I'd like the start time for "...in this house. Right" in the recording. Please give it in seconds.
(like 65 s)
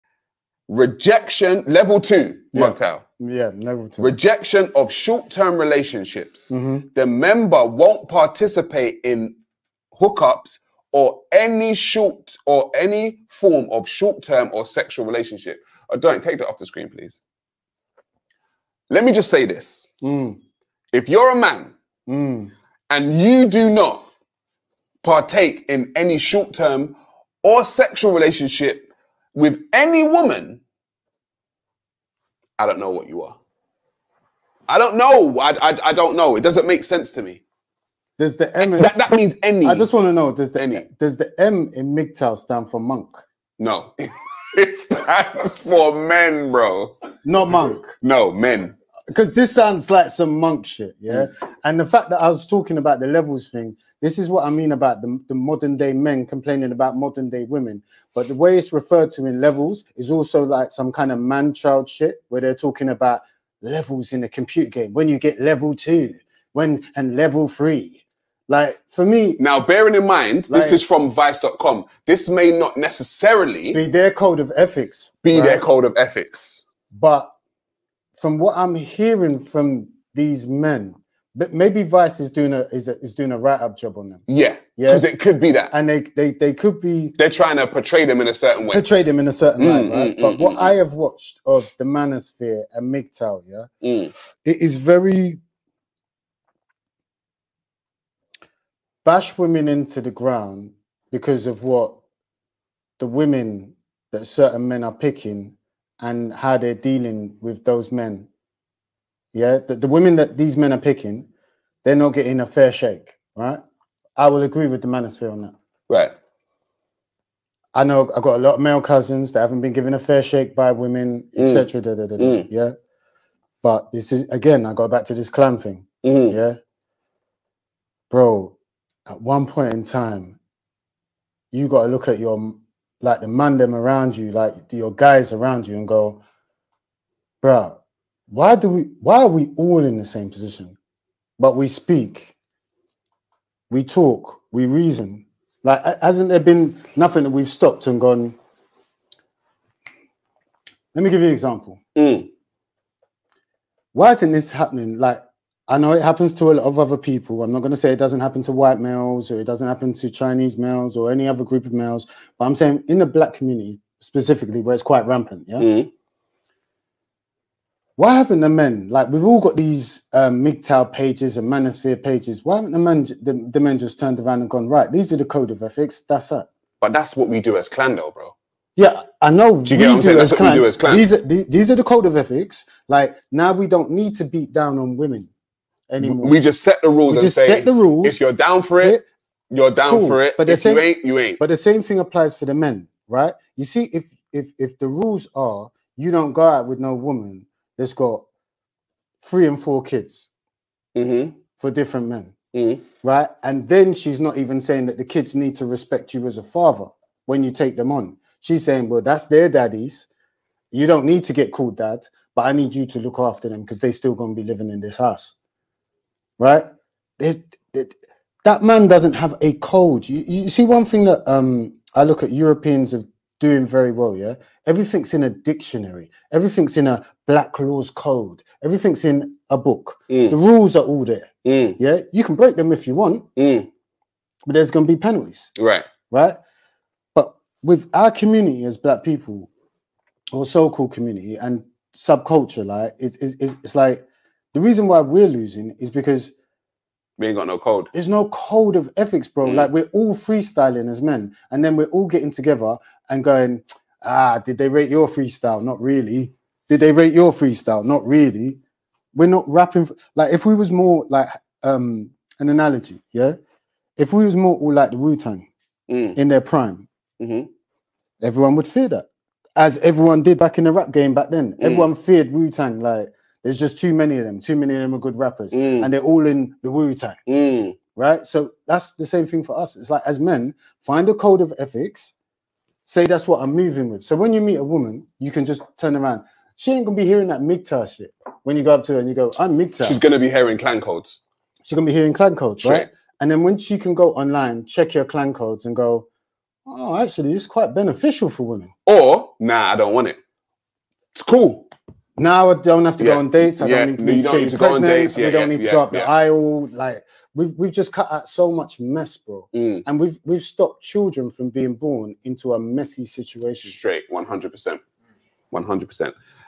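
214 s.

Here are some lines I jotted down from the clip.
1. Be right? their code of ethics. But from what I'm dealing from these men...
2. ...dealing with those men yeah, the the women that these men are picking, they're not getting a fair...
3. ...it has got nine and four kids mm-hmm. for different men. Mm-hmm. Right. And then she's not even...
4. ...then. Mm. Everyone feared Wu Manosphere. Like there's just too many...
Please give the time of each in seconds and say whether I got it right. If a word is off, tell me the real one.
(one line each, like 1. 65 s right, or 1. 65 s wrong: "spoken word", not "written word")
1. 75 s wrong: "hearing", not "dealing"
2. 106 s right
3. 197 s wrong: "three", not "nine"
4. 271 s wrong: "Tang", not "Manosphere".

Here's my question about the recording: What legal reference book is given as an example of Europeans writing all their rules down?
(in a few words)
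Black Laws Code.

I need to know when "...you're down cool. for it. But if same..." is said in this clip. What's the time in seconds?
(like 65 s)
189 s.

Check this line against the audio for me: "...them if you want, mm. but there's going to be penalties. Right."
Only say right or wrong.
right.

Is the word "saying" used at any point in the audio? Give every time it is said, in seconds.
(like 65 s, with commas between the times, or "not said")
162 s, 204 s, 208 s.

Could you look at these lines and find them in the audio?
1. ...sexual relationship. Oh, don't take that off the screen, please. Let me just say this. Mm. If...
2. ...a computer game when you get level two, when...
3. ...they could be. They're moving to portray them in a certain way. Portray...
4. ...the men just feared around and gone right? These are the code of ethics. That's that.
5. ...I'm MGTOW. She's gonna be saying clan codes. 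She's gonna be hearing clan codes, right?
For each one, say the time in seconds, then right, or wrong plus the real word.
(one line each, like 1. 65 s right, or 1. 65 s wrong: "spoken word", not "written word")
1. 14 s right
2. 64 s right
3. 86 s wrong: "trying", not "moving"
4. 173 s wrong: "turned", not "feared"
5. 289 s wrong: "hearing", not "saying".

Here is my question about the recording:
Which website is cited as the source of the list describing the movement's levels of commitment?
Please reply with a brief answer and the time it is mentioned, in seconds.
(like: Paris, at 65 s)
vice.com, at 71 s.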